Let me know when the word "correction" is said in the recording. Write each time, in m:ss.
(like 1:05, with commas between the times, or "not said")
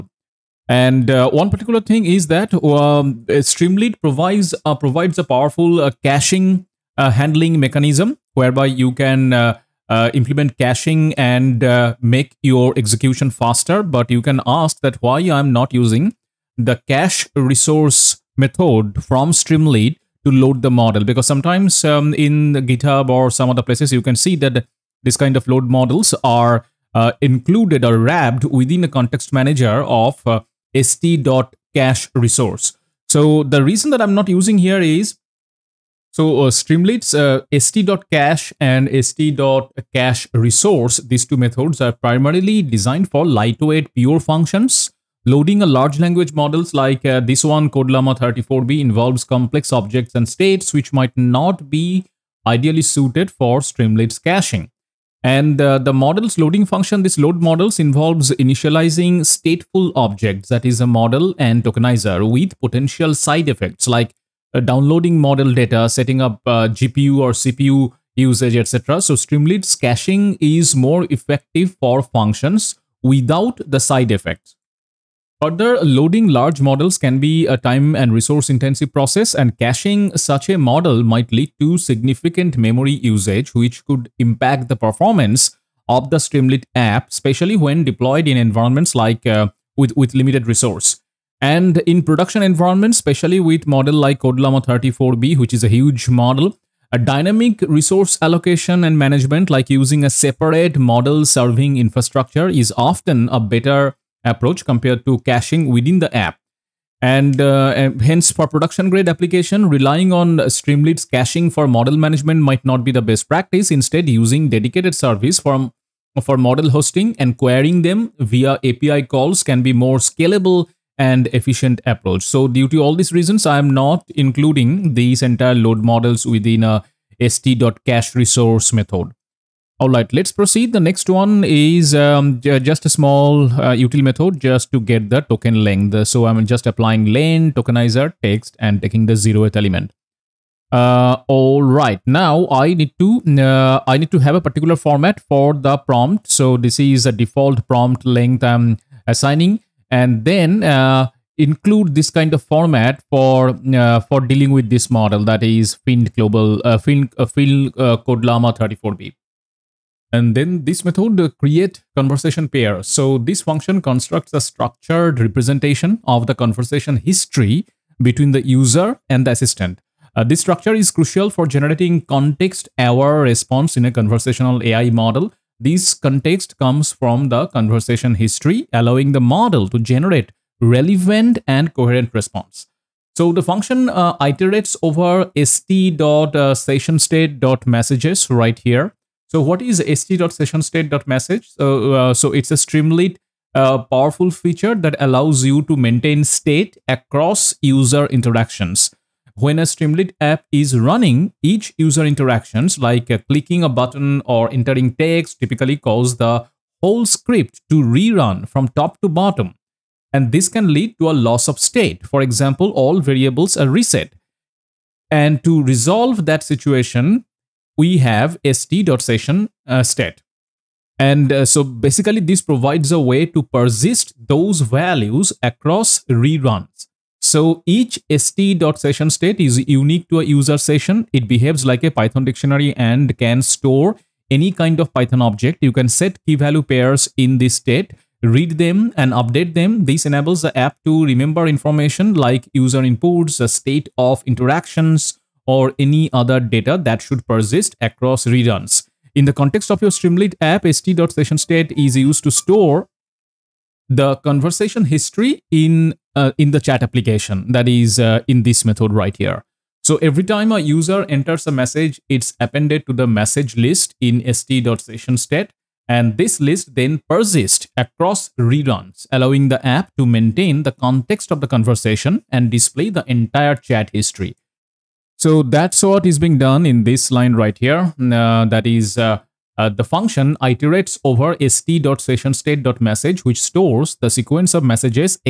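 not said.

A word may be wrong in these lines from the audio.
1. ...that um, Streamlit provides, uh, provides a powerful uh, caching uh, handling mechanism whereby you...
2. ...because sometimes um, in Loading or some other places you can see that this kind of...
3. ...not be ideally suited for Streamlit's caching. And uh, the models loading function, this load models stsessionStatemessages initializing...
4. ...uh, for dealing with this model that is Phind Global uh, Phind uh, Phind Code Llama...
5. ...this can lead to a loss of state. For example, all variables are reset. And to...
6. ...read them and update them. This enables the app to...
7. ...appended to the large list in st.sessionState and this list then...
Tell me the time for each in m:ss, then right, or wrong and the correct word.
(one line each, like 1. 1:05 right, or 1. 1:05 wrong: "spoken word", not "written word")
1. 0:02 right
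2. 0:21 wrong: "GitHub", not "Loading"
3. 0:51 wrong: "involves", not "stsessionStatemessages"
4. 2:33 right
5. 3:30 right
6. 3:58 right
7. 4:22 wrong: "message", not "large".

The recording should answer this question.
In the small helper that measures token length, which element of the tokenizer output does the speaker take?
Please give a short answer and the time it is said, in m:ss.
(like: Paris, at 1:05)
zeroth element, at 2:19.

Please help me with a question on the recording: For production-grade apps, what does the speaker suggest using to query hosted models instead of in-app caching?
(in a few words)
API calls.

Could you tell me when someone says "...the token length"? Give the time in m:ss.
2:15.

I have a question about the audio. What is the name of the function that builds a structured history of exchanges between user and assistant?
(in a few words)
create conversation pair.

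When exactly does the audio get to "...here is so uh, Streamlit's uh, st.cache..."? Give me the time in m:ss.
0:34.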